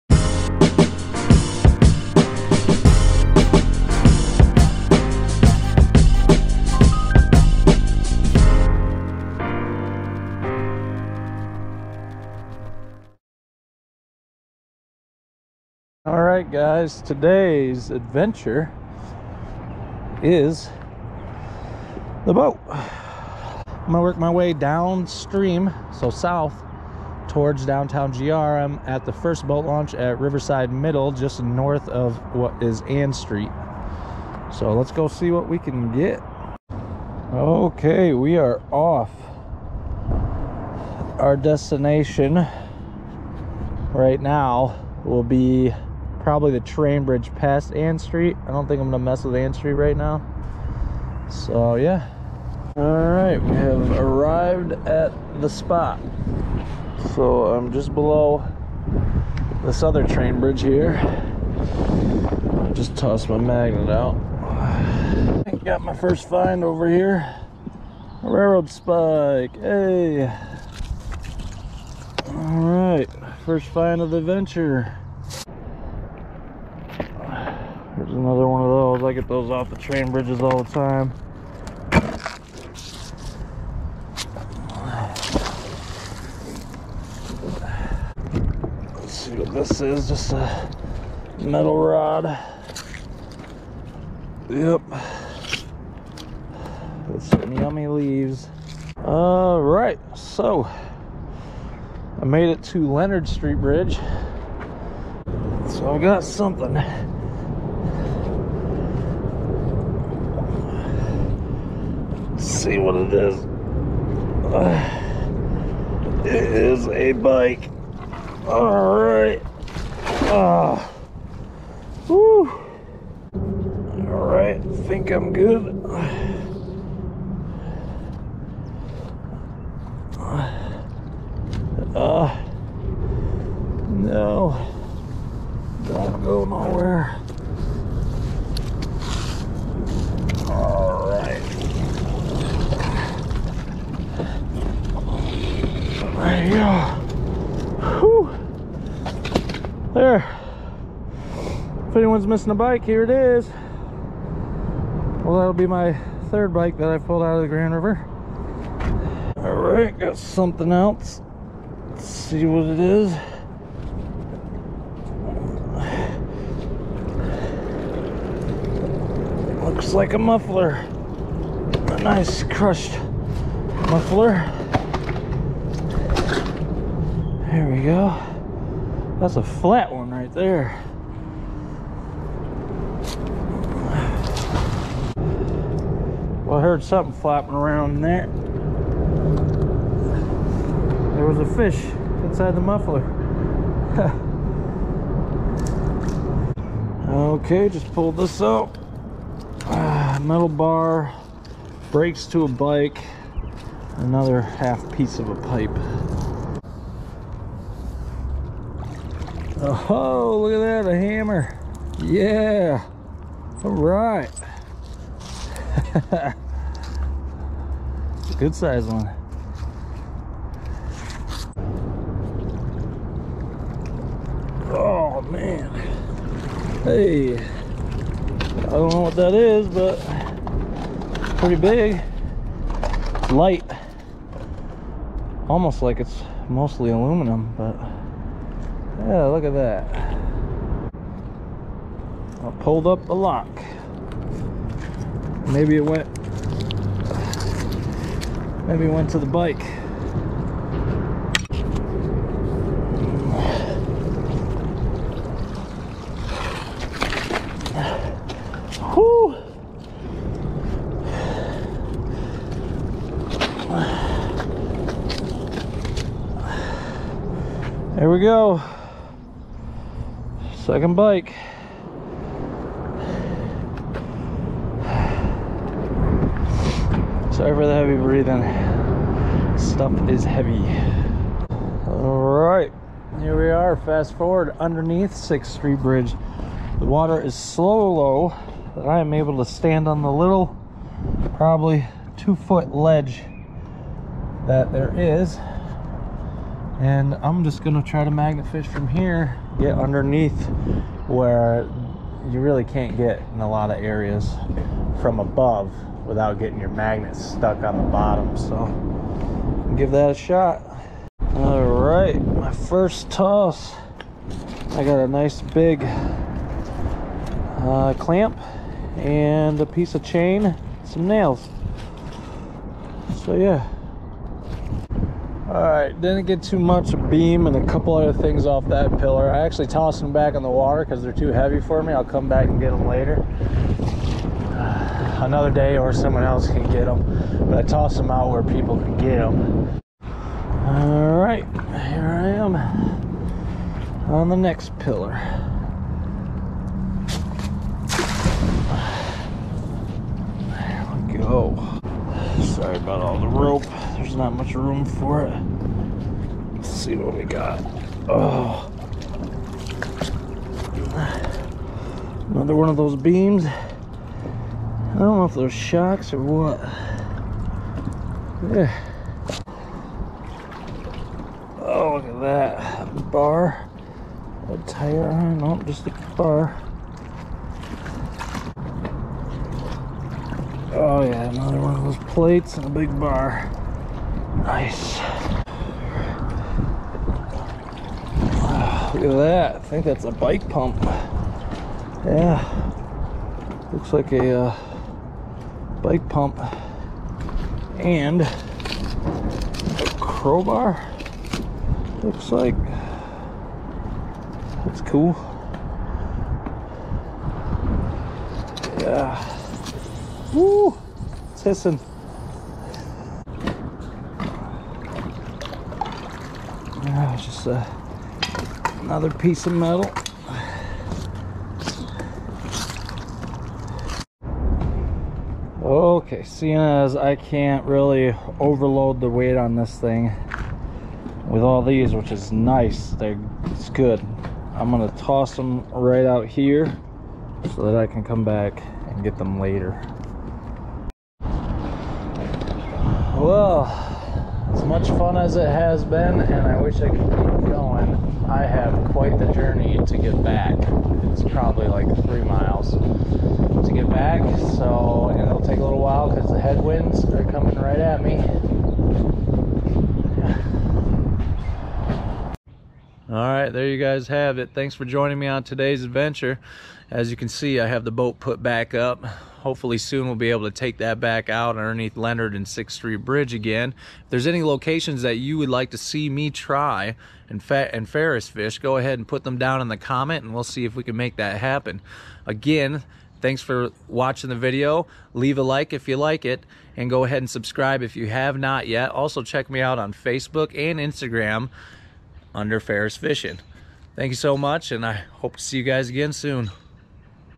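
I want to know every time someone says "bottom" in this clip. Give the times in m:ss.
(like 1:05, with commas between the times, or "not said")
5:07.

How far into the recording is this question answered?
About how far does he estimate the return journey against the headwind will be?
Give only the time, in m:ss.
7:32.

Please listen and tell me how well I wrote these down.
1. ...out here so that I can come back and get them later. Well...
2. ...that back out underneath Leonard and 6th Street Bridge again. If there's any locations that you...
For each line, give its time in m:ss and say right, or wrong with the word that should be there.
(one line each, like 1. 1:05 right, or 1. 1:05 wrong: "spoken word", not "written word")
1. 7:16 right
2. 7:50 right.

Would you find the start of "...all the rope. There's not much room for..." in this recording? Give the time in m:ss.
5:53.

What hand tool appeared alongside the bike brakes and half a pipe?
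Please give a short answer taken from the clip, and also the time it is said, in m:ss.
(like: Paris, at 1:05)
Hammer, at 3:30.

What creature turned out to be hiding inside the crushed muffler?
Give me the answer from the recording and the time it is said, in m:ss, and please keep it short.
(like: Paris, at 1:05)
A fish, at 3:11.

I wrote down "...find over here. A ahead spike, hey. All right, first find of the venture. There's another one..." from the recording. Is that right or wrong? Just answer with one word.
wrong.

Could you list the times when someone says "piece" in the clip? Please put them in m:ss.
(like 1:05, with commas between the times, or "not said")
3:24, 5:19, 6:59.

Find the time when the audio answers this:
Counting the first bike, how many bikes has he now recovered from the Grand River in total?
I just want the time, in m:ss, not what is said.
2:36.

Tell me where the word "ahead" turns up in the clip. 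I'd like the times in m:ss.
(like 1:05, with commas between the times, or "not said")
7:58, 8:07.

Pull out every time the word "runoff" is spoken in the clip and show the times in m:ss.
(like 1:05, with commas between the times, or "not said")
not said.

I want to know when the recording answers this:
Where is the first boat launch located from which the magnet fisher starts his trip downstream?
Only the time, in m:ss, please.
0:30.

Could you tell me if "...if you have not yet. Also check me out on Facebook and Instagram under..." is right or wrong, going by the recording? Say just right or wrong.
right.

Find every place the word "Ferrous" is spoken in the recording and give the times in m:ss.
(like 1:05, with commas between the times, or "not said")
7:57, 8:12.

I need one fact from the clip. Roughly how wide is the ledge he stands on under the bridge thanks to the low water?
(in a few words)
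2 feet.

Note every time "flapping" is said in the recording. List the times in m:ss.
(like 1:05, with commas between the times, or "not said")
3:07.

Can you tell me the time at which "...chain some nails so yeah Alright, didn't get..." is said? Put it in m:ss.
5:20.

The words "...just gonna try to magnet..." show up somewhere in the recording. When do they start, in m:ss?
4:57.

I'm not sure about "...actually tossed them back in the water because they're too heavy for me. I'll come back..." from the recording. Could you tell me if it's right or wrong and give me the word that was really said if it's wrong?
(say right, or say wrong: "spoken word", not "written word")
right.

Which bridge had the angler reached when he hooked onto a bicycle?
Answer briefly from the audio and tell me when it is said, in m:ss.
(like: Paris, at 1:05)
Leonard Street Bridge, at 1:42.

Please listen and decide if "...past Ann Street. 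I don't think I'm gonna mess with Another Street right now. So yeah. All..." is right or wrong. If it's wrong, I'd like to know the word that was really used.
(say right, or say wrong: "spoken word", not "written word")
wrong: "Ann", not "Another".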